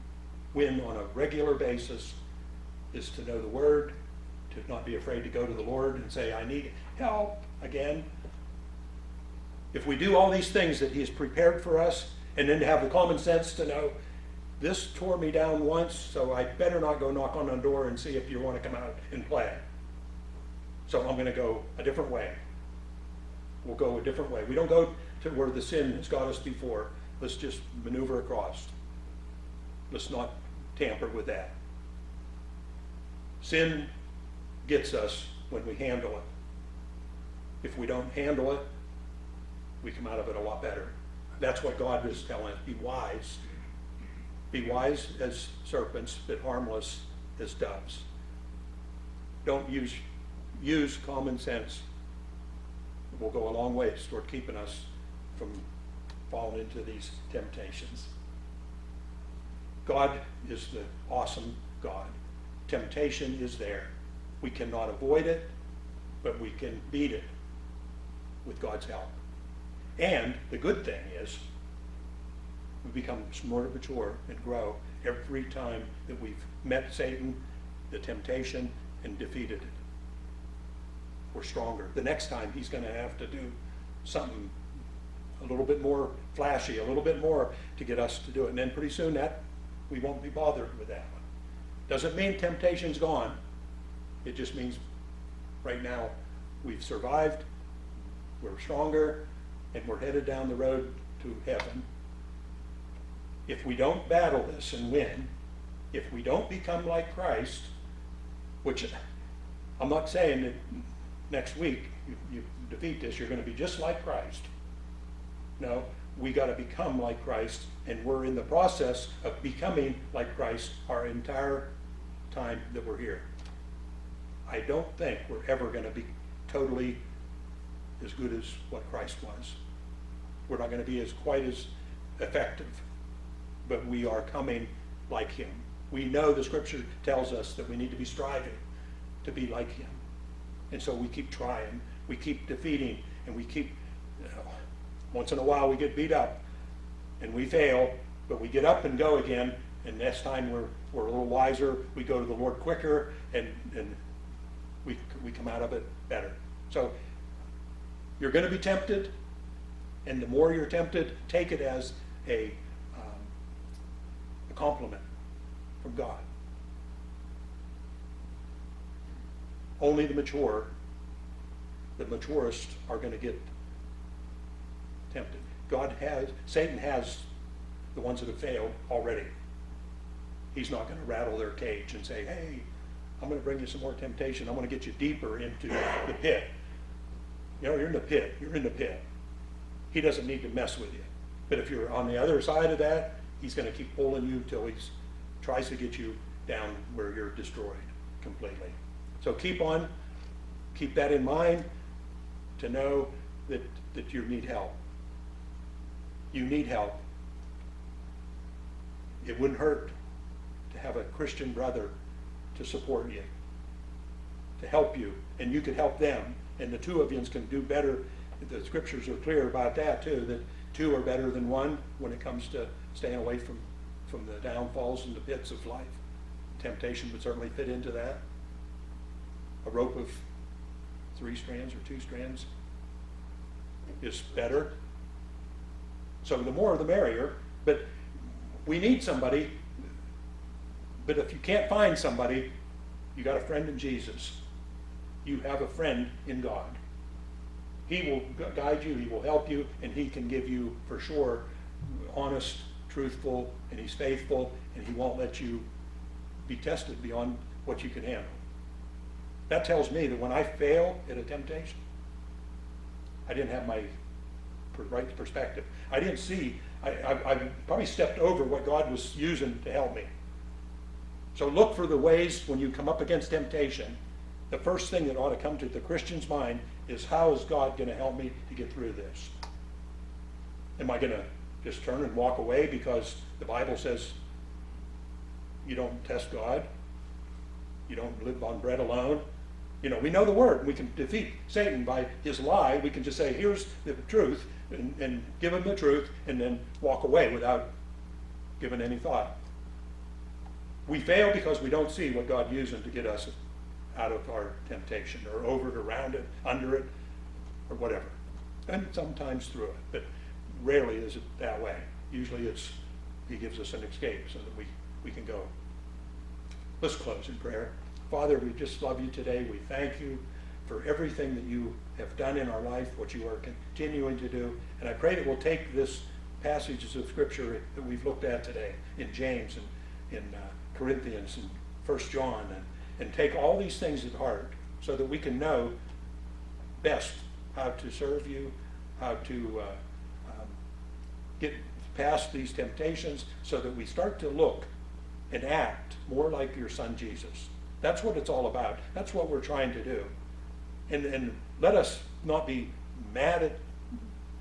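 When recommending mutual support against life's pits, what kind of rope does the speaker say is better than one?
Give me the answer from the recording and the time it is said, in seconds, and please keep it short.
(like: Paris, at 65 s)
A rope of three strands, at 229 s.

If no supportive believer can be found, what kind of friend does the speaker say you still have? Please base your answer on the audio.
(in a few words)
A friend in Jesus.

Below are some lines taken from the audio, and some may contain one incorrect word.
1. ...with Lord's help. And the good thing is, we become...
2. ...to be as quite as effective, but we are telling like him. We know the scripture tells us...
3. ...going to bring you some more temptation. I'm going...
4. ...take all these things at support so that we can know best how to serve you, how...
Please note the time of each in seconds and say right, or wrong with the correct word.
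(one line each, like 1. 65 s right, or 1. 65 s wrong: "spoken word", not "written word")
1. 68 s wrong: "God", not "Lord"
2. 130 s wrong: "coming", not "telling"
3. 183 s right
4. 333 s wrong: "heart", not "support".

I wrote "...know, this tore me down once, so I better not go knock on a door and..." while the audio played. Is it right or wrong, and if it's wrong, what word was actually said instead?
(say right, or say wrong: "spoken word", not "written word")
right.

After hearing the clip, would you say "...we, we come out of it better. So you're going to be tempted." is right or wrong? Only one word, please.
right.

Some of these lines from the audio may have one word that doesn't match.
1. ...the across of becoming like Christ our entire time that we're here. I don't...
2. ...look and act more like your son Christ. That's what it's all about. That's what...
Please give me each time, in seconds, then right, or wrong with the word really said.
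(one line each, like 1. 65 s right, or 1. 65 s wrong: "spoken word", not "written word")
1. 118 s wrong: "process", not "across"
2. 344 s wrong: "Jesus", not "Christ".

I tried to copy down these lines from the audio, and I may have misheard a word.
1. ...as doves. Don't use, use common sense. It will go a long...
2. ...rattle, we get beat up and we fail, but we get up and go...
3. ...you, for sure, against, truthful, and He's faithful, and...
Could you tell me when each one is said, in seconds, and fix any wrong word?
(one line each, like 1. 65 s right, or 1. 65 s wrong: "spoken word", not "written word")
1. 47 s right
2. 145 s wrong: "while", not "rattle"
3. 250 s wrong: "honest", not "against".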